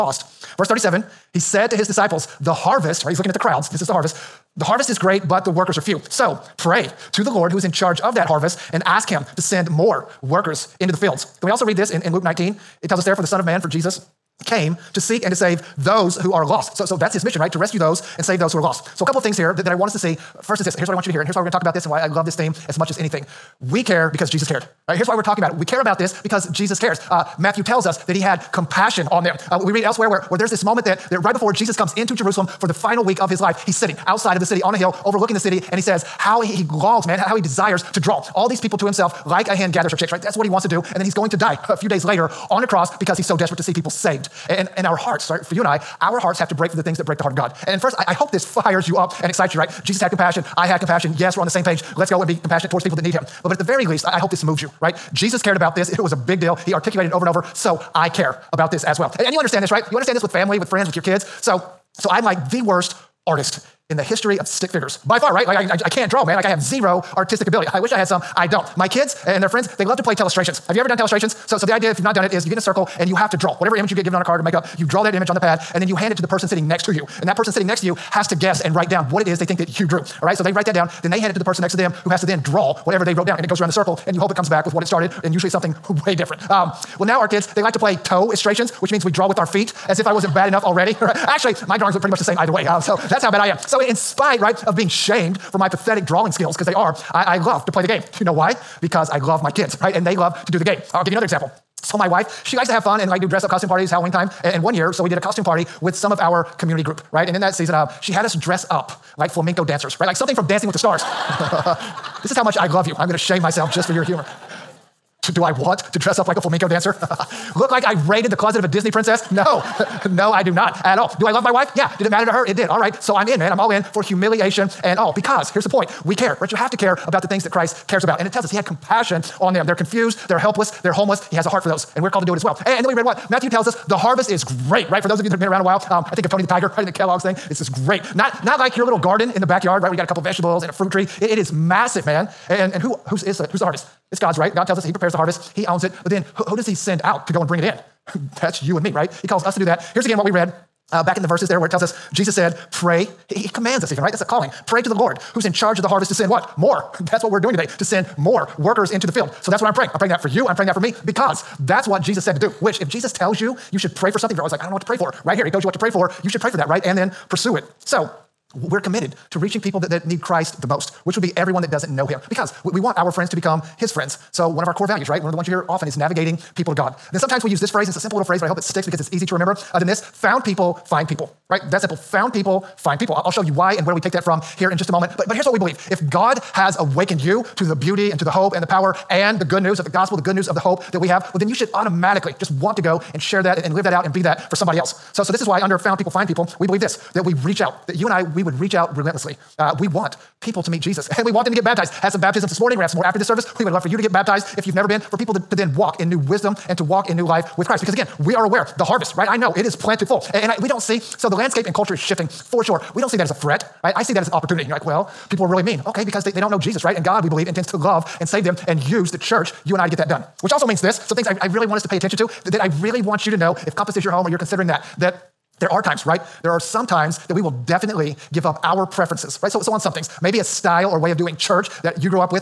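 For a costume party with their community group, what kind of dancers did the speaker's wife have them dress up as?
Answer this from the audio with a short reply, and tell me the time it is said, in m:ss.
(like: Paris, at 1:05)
Flamenco dancers, at 1:49.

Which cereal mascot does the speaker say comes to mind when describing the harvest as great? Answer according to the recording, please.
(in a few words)
Tony the Tiger.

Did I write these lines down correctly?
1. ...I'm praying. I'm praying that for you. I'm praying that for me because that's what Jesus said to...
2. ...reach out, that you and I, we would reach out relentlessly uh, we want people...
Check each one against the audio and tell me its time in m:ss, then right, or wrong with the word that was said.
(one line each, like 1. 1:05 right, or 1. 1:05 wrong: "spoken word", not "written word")
1. 2:39 right
2. 3:17 right.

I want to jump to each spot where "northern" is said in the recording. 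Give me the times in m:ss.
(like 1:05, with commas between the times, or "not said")
not said.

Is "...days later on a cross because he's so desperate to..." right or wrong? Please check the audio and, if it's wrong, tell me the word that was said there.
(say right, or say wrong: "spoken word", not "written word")
right.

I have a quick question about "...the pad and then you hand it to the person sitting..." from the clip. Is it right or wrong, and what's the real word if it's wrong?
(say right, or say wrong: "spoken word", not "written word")
right.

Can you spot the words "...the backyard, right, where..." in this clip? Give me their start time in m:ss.
2:19.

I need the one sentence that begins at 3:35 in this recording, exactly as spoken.
Okay, because they, they don't know Jesus, right?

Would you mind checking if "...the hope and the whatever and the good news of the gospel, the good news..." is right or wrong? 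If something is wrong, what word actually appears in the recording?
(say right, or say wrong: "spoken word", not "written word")
wrong: "power", not "whatever".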